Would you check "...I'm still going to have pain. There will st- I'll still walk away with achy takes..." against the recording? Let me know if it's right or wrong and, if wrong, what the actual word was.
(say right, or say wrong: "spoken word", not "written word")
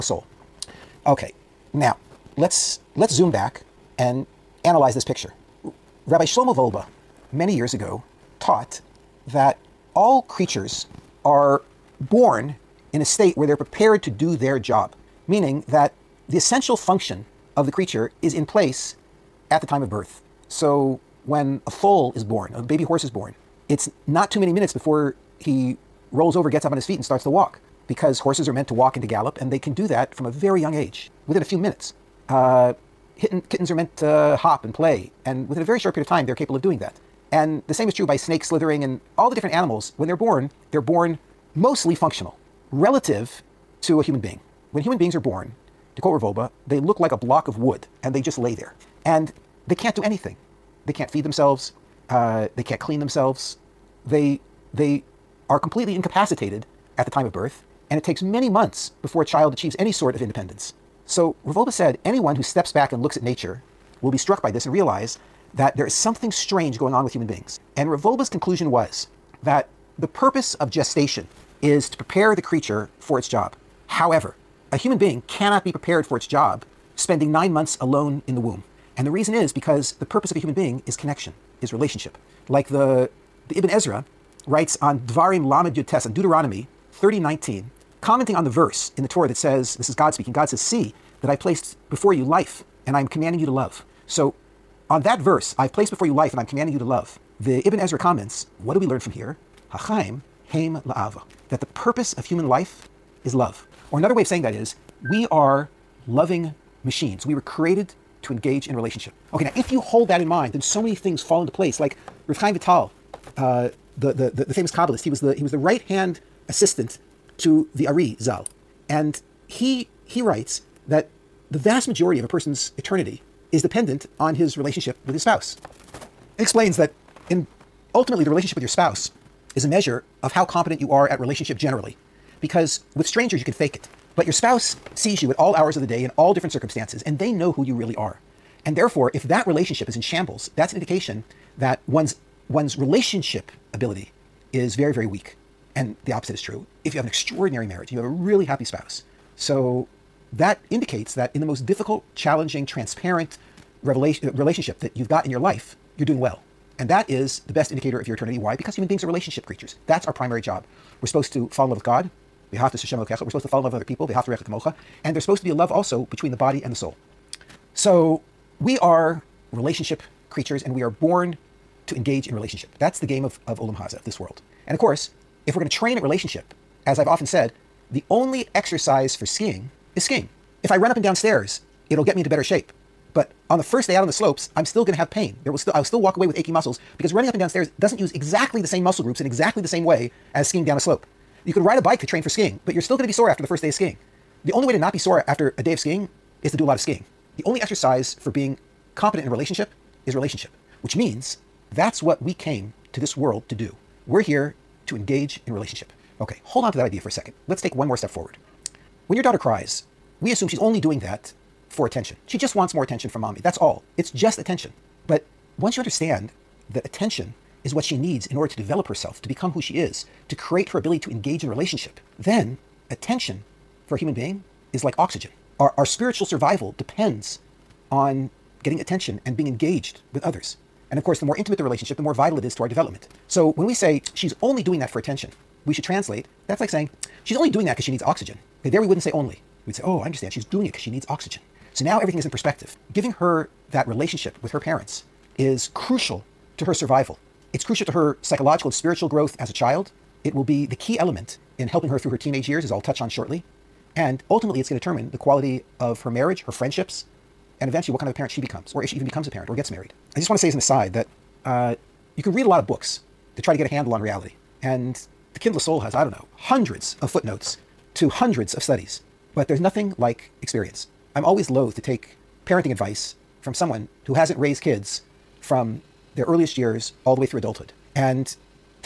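wrong: "muscles", not "takes".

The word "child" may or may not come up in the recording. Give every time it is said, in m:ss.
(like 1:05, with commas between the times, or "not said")
0:59, 4:09.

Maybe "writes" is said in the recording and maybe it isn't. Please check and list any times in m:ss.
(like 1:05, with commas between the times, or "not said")
1:24, 2:00.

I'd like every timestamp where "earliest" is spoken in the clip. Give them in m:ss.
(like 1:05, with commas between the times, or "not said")
4:36.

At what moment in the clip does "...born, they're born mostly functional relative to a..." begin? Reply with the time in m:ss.
0:40.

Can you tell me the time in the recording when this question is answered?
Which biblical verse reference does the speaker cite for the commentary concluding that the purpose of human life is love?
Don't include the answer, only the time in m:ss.
1:26.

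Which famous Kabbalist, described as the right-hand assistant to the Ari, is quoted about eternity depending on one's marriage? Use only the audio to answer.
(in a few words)
Rav Chaim Vital.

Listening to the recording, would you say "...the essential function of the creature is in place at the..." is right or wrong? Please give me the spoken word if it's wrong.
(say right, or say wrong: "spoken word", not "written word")
right.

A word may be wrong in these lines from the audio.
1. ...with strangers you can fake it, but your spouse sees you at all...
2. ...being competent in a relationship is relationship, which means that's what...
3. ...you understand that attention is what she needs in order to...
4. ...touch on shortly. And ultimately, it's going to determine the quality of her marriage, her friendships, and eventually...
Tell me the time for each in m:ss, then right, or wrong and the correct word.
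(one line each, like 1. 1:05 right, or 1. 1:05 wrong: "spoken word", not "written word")
1. 2:12 right
2. 3:18 right
3. 3:35 right
4. 4:12 right.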